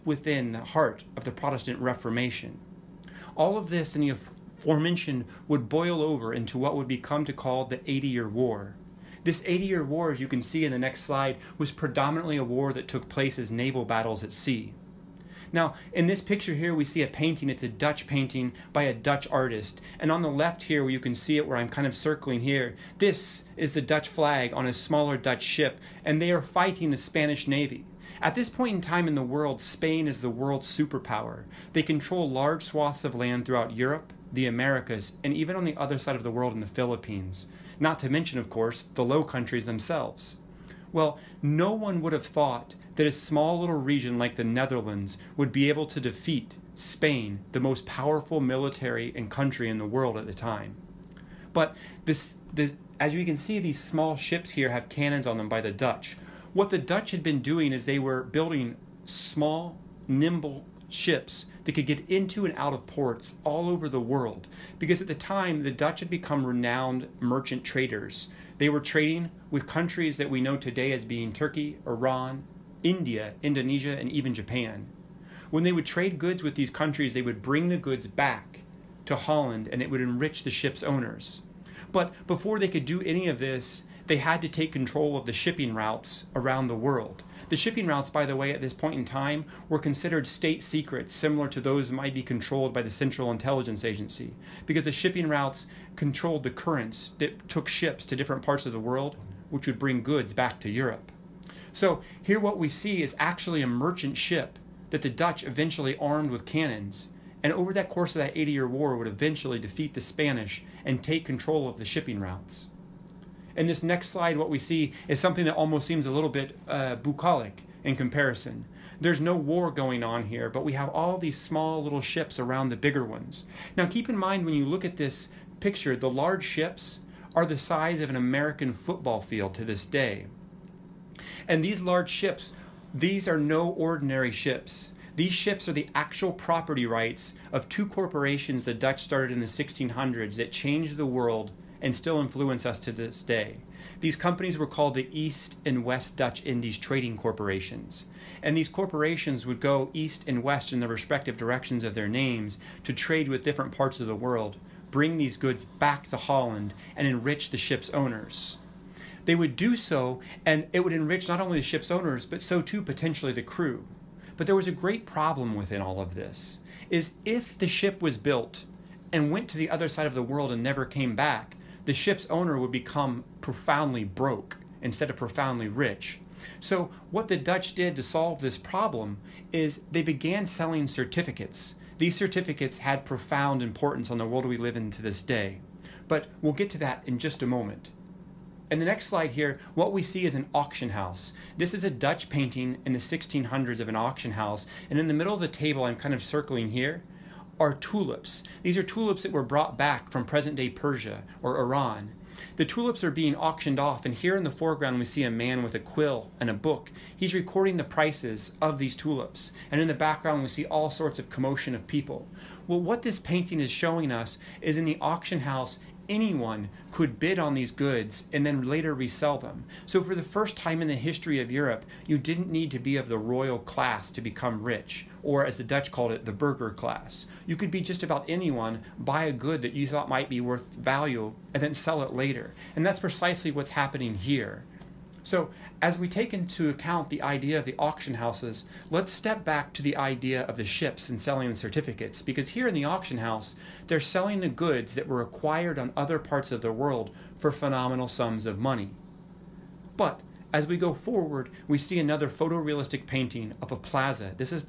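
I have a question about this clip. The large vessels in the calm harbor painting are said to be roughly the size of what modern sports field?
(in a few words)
American football field.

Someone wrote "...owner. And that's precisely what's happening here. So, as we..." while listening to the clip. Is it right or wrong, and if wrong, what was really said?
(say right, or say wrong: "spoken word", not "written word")
wrong: "later", not "owner".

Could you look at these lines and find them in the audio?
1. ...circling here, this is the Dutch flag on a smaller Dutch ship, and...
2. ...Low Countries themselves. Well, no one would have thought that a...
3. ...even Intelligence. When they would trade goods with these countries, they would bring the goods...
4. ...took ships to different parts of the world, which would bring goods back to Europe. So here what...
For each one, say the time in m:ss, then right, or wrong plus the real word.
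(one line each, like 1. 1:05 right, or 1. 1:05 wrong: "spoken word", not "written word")
1. 0:21 right
2. 0:39 right
3. 1:14 wrong: "Japan", not "Intelligence"
4. 1:37 right.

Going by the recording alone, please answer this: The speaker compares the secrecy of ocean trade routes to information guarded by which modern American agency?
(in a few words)
Central Intelligence Agency.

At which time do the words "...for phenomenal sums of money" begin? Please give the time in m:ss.
4:07.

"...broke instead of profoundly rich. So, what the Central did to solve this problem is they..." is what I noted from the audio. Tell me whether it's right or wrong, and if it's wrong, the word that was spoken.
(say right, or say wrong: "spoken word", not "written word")
wrong: "Dutch", not "Central".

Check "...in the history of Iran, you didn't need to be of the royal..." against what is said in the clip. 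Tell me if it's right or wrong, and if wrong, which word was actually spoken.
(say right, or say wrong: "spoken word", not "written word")
wrong: "Europe", not "Iran".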